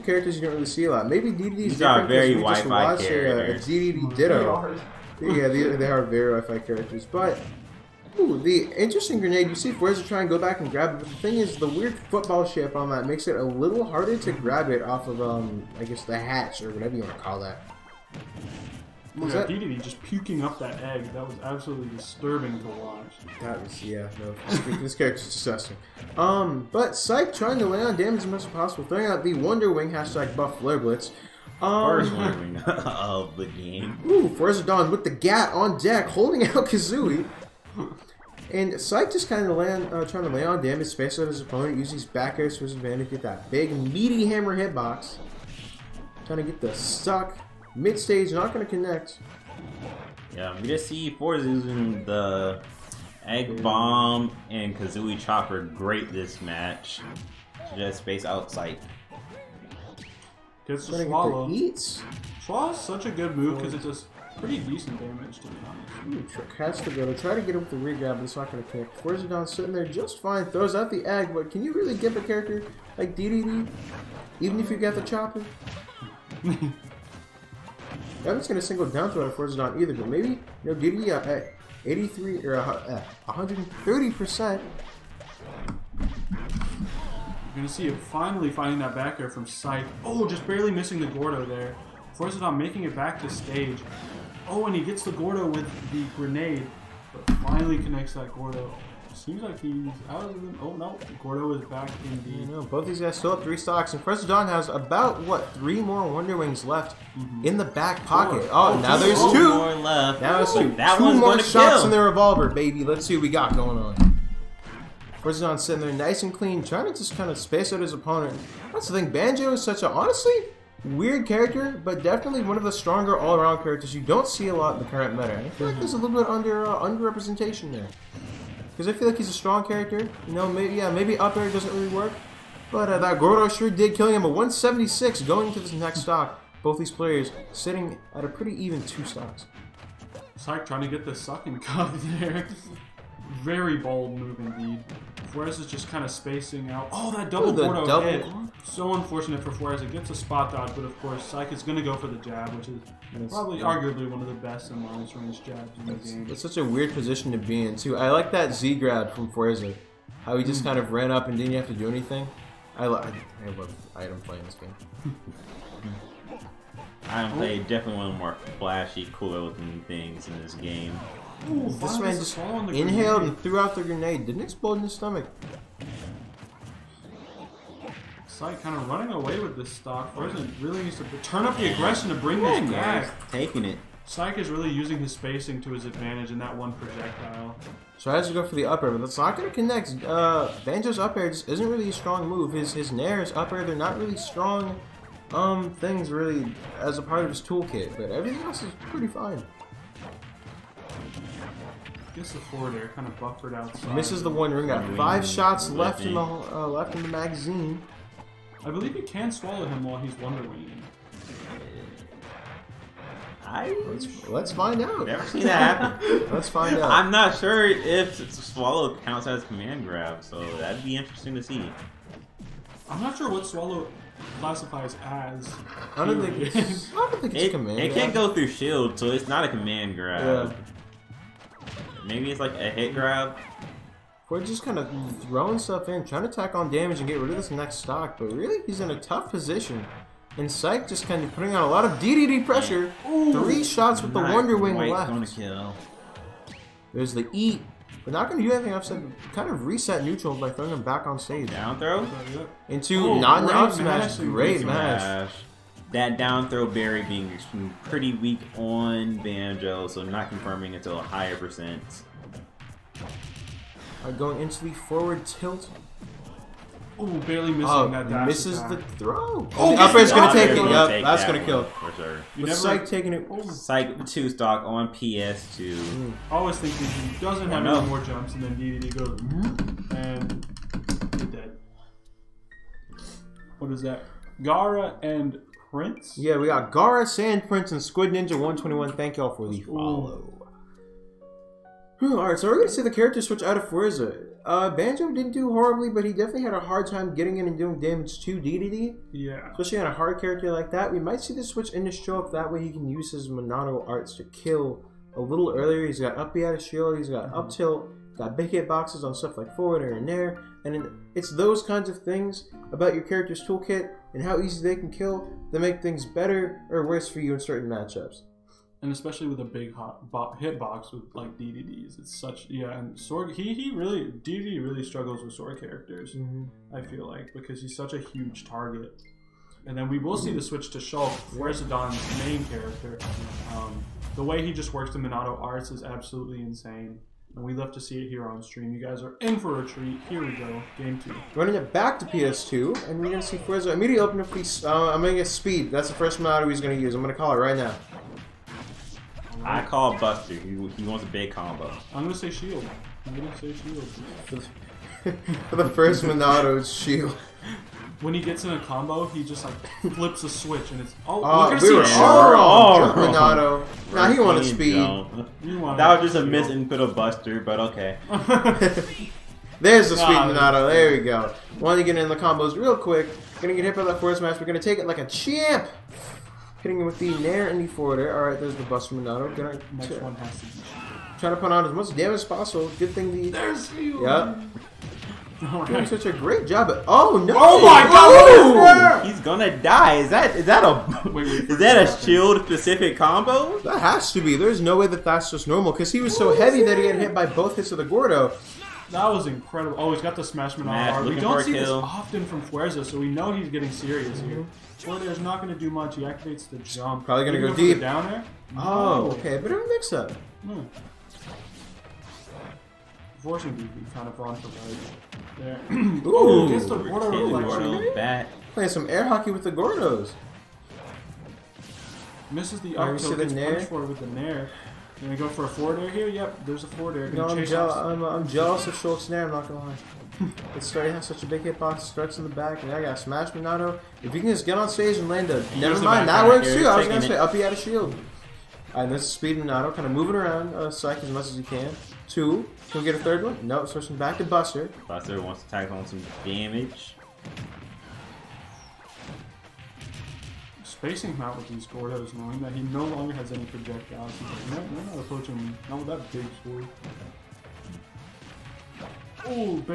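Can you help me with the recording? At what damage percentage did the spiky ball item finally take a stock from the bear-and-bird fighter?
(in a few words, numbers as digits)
176.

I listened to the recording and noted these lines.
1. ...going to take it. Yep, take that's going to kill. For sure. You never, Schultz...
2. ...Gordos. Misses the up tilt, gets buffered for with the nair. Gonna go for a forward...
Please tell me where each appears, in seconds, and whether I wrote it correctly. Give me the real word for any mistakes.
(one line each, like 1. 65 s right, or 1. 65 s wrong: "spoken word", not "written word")
1. 269 s wrong: "Psyke", not "Schultz"
2. 419 s wrong: "punched", not "buffered".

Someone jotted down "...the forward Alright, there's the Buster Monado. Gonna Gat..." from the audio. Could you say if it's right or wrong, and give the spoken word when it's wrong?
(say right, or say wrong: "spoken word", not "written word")
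wrong: "Next", not "Gat".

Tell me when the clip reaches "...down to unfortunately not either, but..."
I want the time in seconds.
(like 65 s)
78 s.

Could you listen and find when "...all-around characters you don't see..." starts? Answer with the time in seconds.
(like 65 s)
123 s.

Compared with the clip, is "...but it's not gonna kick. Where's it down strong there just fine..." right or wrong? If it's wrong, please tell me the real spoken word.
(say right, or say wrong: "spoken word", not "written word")
wrong: "sitting", not "strong".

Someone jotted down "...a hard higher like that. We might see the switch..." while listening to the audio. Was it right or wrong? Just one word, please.
wrong.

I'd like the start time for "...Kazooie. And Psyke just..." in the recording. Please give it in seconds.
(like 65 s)
36 s.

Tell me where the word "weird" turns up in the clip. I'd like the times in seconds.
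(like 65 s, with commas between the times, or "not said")
11 s, 120 s, 156 s.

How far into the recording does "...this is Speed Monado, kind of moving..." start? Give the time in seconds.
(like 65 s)
438 s.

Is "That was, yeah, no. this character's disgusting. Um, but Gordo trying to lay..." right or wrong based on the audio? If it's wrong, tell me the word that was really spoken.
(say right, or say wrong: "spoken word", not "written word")
wrong: "Psyke", not "Gordo".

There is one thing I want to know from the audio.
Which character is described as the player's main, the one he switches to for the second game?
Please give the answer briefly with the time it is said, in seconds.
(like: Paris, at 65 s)
Shulk, at 330 s.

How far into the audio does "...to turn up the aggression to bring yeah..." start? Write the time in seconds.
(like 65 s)
180 s.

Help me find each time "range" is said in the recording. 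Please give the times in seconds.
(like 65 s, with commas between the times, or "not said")
155 s.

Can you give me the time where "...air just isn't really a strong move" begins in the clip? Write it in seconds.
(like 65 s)
191 s.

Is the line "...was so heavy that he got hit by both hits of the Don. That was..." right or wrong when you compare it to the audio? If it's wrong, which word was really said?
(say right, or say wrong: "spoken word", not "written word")
wrong: "Gordo", not "Don".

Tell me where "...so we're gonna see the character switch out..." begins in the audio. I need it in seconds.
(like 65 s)
292 s.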